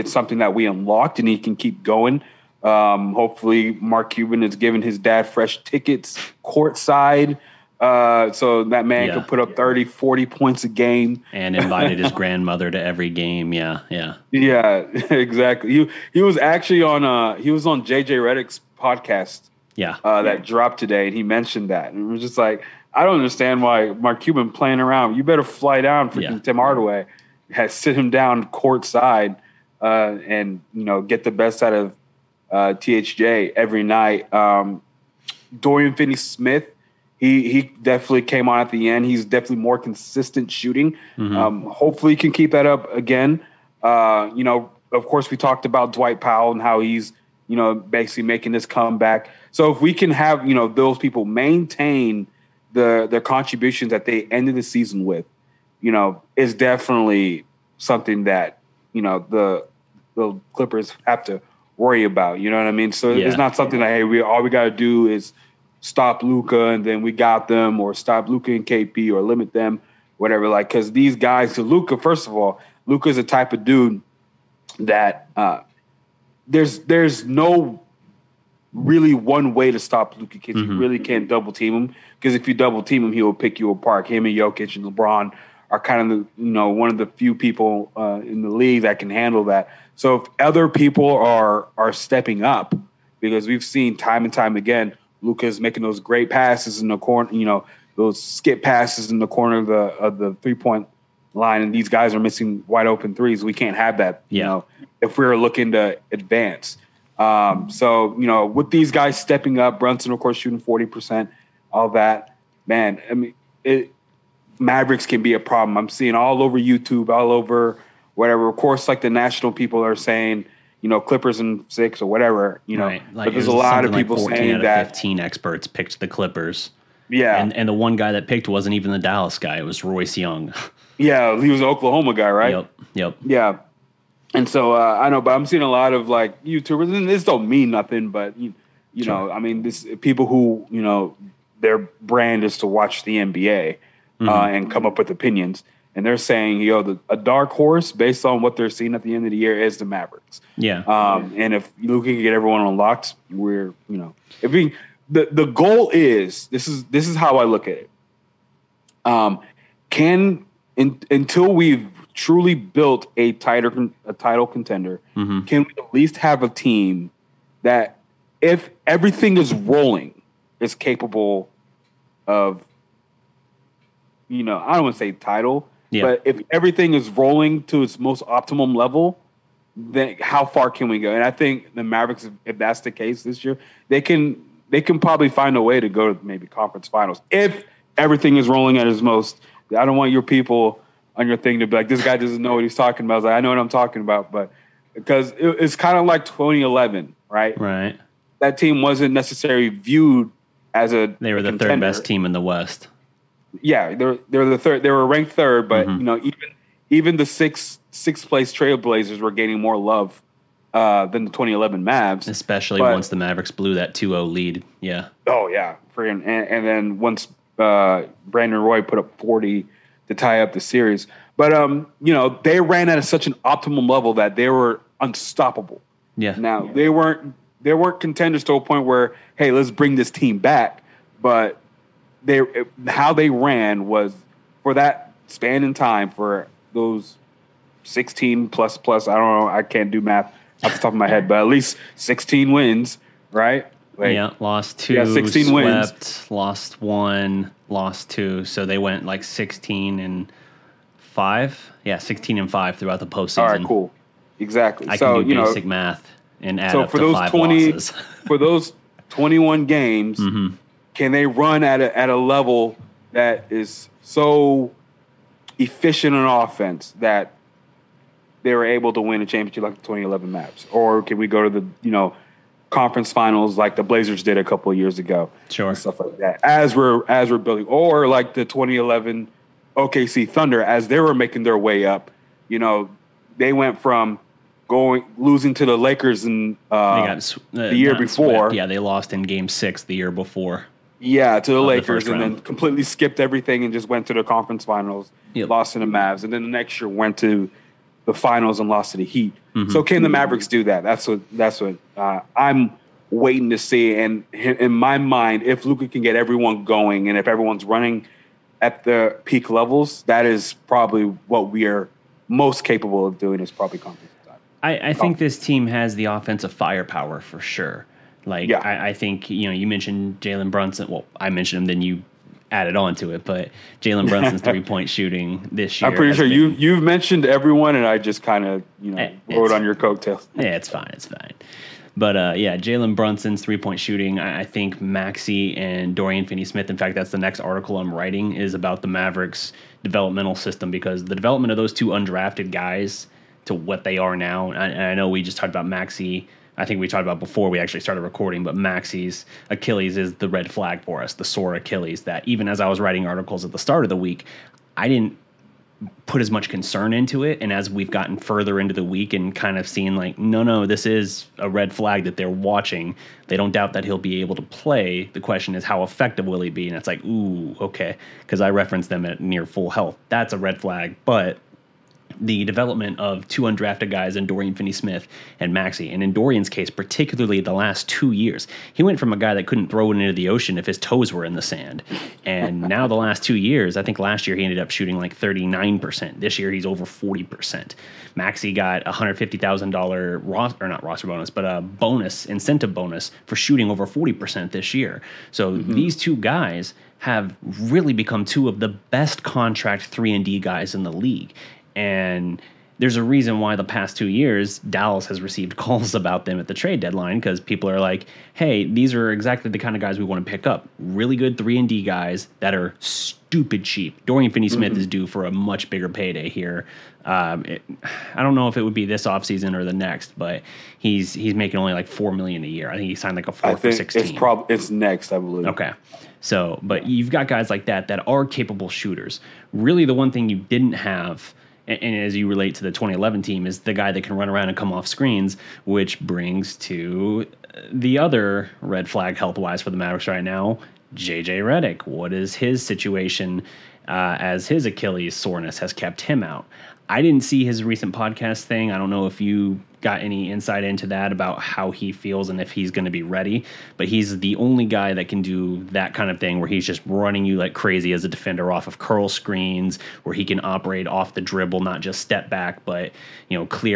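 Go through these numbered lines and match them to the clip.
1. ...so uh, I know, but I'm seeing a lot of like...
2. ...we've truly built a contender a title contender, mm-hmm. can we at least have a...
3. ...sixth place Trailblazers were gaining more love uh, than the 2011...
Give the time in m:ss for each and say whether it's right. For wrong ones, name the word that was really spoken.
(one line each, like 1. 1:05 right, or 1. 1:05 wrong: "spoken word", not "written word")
1. 2:14 right
2. 2:41 wrong: "tighter", not "contender"
3. 3:27 right.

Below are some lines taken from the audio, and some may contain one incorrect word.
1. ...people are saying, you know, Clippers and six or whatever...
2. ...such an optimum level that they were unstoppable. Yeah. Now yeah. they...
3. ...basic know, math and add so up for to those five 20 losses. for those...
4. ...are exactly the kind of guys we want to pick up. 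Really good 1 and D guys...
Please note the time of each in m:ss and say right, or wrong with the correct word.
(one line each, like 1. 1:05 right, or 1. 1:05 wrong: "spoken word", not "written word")
1. 1:59 right
2. 3:43 right
3. 4:15 right
4. 6:48 wrong: "3", not "1".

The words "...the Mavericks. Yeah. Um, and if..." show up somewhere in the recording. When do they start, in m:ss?
2:29.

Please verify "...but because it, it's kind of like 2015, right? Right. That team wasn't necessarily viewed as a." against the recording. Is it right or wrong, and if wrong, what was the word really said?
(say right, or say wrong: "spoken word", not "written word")
wrong: "2011", not "2015".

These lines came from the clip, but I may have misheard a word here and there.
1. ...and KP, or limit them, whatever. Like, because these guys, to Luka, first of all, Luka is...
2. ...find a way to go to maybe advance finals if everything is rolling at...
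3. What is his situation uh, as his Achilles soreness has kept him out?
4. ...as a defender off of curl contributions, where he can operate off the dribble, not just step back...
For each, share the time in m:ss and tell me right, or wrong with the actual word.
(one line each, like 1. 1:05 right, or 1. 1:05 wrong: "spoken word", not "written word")
1. 1:08 right
2. 3:05 wrong: "conference", not "advance"
3. 7:21 right
4. 7:37 wrong: "screens", not "contributions".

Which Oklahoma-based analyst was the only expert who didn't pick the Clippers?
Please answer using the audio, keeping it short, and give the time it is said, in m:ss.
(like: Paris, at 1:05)
Royce Young, at 2:09.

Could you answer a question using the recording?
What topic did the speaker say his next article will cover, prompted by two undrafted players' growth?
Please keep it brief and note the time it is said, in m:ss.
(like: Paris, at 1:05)
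Mavericks developmental system, at 5:38.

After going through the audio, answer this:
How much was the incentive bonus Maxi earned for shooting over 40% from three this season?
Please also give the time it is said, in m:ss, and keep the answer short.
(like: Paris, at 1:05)
$150,000, at 6:28.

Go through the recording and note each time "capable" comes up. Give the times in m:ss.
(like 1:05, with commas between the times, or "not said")
2:50, 5:12, 7:08.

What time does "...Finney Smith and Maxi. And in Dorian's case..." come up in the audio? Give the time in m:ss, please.
6:14.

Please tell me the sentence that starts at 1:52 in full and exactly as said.
Man, I mean, it, Mavericks can be a problem.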